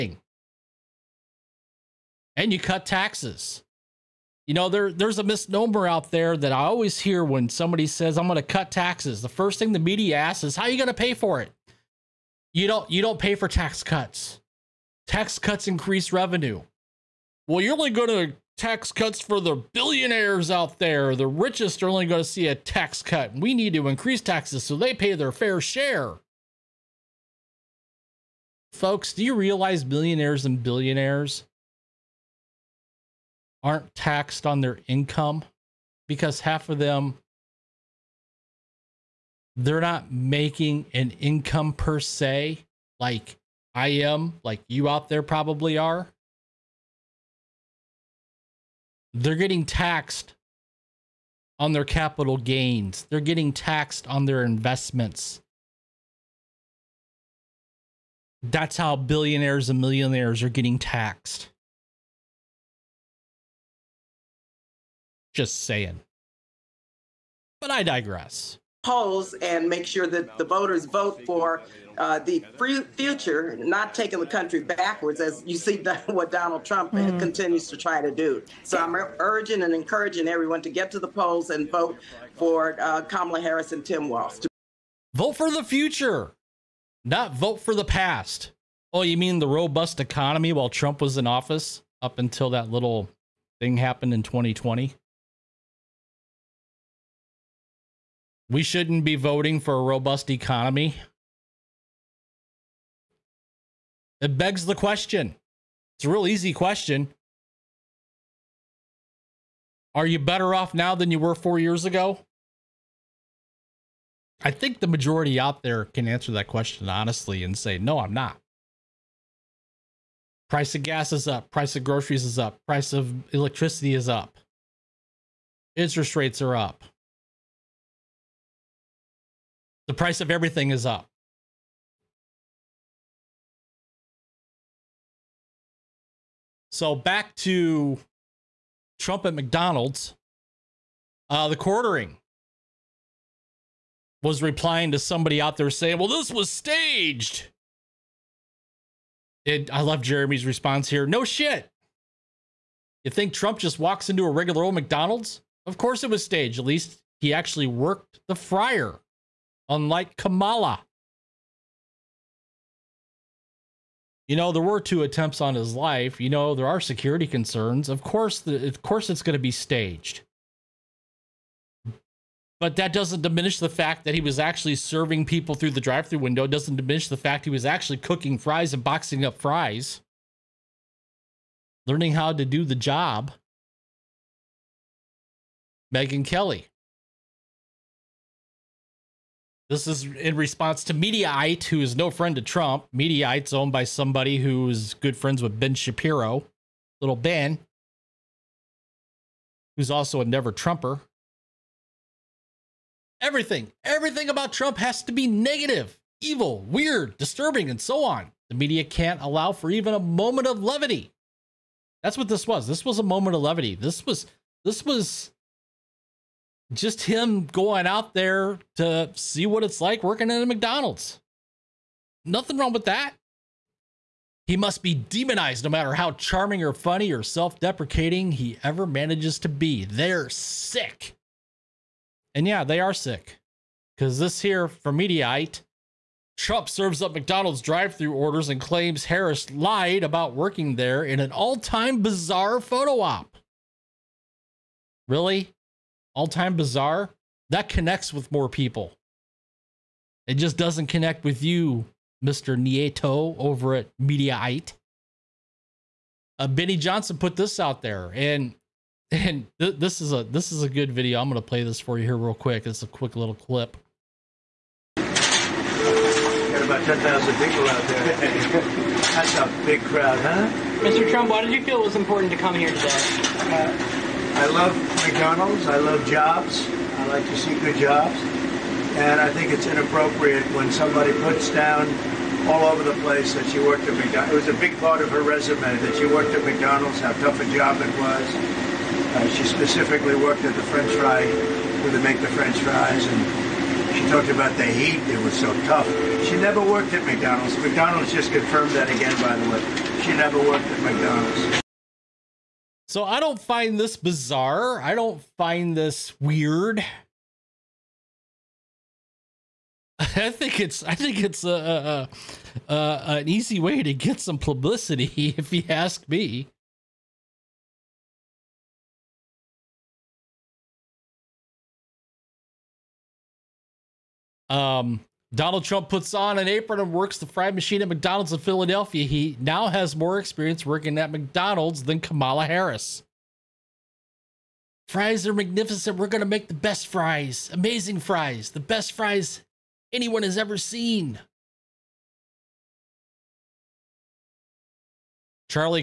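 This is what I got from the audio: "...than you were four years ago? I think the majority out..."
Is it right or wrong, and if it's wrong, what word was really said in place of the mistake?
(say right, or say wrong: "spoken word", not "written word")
right.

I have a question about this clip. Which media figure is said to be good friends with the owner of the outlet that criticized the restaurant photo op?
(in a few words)
Ben Shapiro.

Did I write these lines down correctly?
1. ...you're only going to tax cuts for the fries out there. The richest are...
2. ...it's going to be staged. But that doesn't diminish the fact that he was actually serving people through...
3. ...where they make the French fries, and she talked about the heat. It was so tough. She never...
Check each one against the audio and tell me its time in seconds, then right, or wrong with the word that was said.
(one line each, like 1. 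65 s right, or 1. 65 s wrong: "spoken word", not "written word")
1. 17 s wrong: "billionaires", not "fries"
2. 169 s right
3. 291 s right.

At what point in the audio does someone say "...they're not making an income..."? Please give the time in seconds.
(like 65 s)
39 s.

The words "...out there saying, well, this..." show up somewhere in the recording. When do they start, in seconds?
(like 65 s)
145 s.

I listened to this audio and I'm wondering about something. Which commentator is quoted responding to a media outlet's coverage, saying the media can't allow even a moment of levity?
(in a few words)
Megyn Kelly.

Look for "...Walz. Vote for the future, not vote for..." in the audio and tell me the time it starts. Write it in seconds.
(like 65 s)
84 s.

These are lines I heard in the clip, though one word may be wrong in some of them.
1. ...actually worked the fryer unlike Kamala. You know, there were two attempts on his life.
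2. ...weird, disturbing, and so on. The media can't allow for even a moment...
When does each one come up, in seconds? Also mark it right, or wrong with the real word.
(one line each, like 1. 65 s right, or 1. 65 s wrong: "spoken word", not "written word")
1. 157 s right
2. 206 s right.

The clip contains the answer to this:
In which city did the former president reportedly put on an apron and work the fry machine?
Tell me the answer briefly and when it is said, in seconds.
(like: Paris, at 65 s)
Philadelphia, at 328 s.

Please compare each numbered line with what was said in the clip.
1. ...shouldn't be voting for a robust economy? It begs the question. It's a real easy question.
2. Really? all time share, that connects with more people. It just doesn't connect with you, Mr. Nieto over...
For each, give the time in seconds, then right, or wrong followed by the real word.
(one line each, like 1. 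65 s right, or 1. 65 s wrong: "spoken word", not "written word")
1. 98 s right
2. 245 s wrong: "bizarre", not "share".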